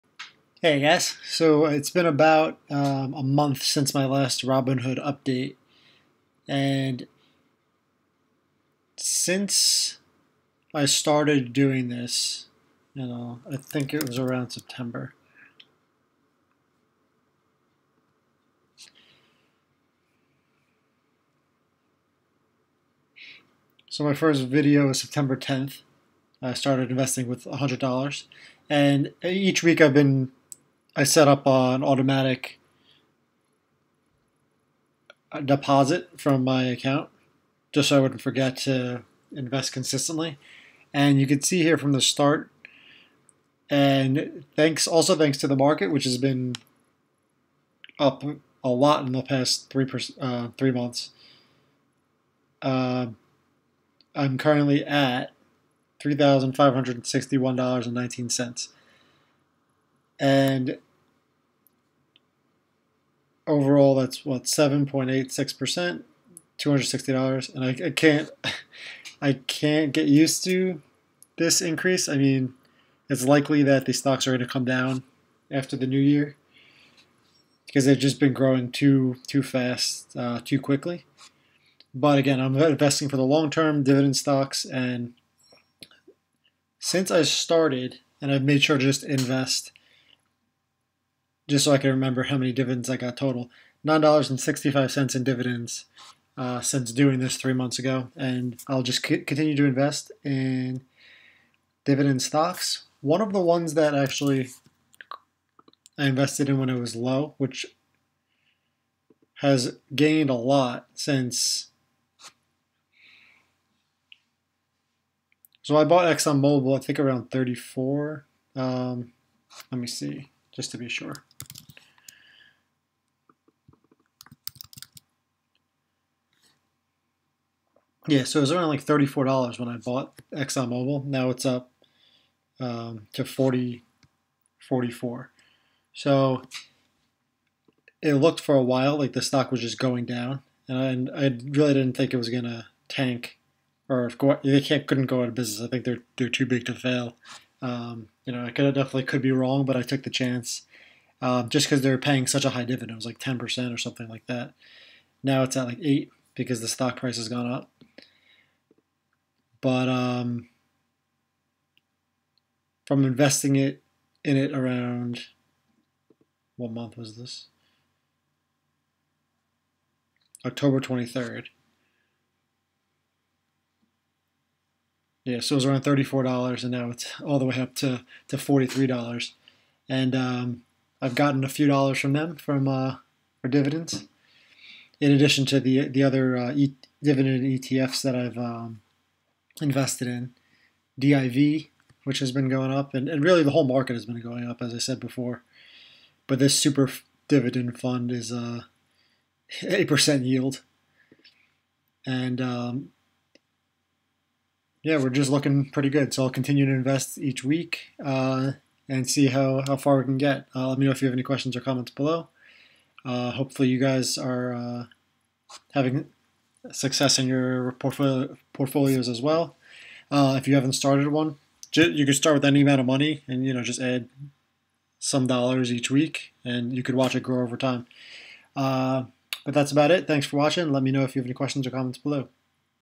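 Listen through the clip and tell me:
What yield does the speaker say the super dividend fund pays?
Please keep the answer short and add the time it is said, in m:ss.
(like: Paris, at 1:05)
8%, at 3:19.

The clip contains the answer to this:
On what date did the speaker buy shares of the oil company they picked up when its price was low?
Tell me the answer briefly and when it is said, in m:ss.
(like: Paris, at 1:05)
October 23rd, at 2:50.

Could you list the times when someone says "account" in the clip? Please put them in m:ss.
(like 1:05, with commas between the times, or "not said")
0:36.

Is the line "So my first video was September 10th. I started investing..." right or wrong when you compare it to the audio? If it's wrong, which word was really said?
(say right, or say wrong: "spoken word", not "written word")
right.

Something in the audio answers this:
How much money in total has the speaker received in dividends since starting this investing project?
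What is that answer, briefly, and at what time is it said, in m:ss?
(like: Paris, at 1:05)
$9.65, at 1:33.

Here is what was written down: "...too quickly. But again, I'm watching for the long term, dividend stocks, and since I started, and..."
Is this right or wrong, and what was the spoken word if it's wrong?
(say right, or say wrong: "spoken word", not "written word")
wrong: "investing", not "watching".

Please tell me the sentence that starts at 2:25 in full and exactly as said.
I think they're they're too big to fail.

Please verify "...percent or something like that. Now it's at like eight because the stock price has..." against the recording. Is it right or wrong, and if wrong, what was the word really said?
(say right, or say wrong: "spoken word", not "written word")
right.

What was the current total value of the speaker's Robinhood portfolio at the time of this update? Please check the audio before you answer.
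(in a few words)
$3,561.19.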